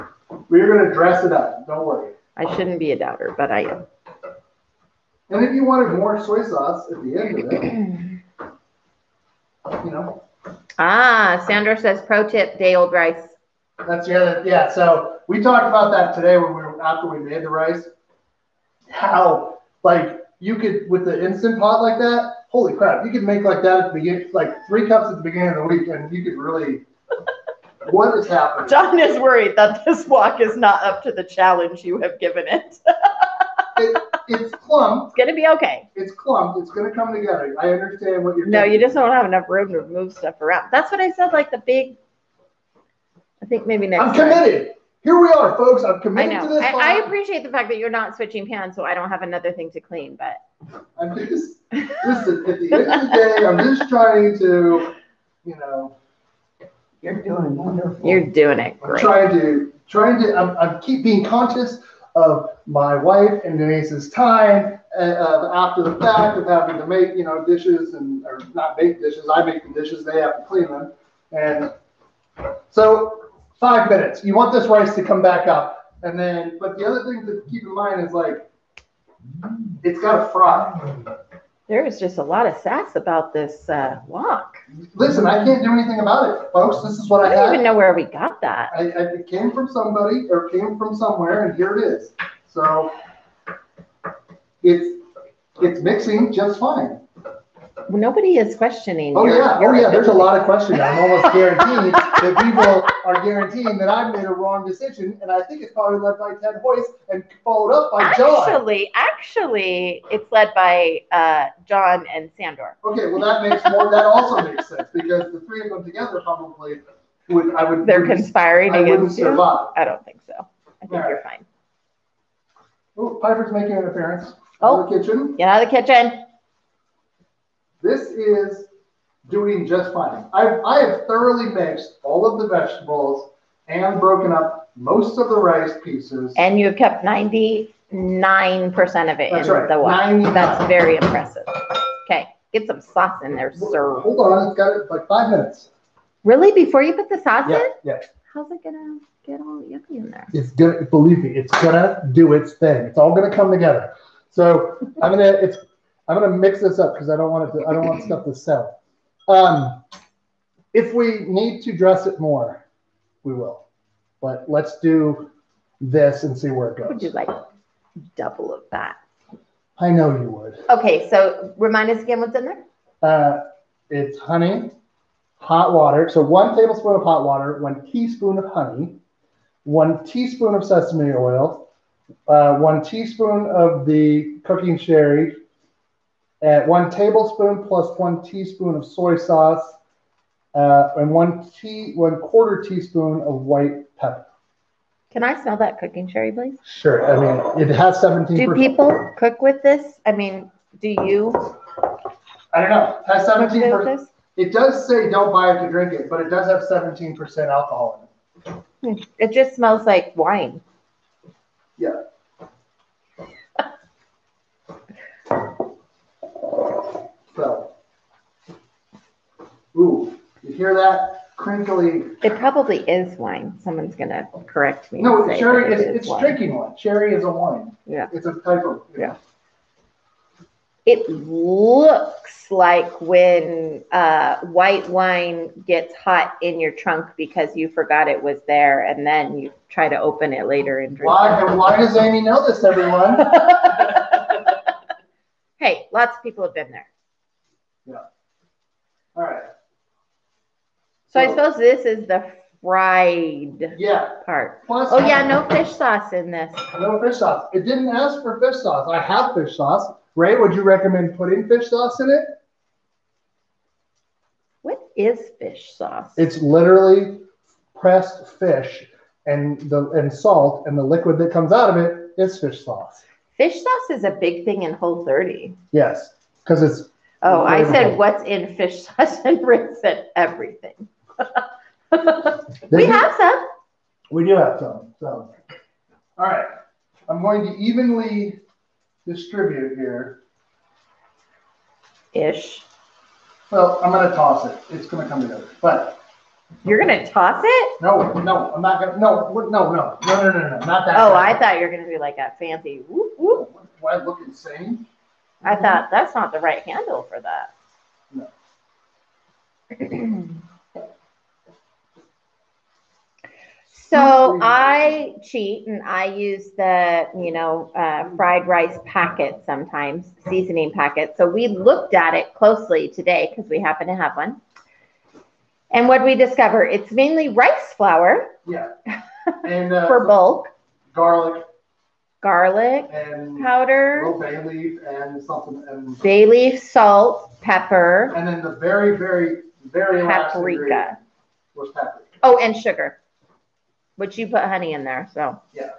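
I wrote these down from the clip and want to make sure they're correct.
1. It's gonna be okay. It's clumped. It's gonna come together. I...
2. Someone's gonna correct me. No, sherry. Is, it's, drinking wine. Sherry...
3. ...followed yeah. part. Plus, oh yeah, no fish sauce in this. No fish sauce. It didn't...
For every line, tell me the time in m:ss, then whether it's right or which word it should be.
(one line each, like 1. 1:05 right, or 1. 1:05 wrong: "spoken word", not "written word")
1. 0:35 right
2. 3:43 right
3. 4:12 wrong: "fried", not "followed".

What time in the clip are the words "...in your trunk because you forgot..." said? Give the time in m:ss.
3:56.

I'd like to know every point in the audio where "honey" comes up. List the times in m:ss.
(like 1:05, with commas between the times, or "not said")
2:54, 2:58, 5:44.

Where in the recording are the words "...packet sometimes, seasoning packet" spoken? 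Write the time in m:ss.
5:18.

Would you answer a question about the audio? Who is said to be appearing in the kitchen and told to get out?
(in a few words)
Piper.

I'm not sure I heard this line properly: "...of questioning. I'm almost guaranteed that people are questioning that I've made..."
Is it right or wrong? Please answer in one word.
wrong.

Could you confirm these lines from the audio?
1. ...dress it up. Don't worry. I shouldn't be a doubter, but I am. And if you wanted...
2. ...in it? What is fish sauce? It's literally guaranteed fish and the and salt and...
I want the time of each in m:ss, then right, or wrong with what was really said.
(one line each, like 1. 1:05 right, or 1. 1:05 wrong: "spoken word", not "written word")
1. 0:00 right
2. 4:21 wrong: "pressed", not "guaranteed".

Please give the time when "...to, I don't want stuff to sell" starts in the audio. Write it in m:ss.
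2:37.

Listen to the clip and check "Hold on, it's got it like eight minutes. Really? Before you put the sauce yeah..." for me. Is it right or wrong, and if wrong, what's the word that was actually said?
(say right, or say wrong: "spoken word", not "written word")
wrong: "five", not "eight".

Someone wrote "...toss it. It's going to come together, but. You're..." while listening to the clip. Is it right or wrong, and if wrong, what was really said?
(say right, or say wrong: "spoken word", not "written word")
right.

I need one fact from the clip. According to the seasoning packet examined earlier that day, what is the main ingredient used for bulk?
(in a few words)
Rice flour.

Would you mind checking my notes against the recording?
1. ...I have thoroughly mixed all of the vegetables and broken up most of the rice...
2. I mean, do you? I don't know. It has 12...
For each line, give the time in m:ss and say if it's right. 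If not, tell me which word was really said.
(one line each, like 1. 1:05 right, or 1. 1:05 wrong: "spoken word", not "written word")
1. 2:10 right
2. 3:20 wrong: "17", not "12".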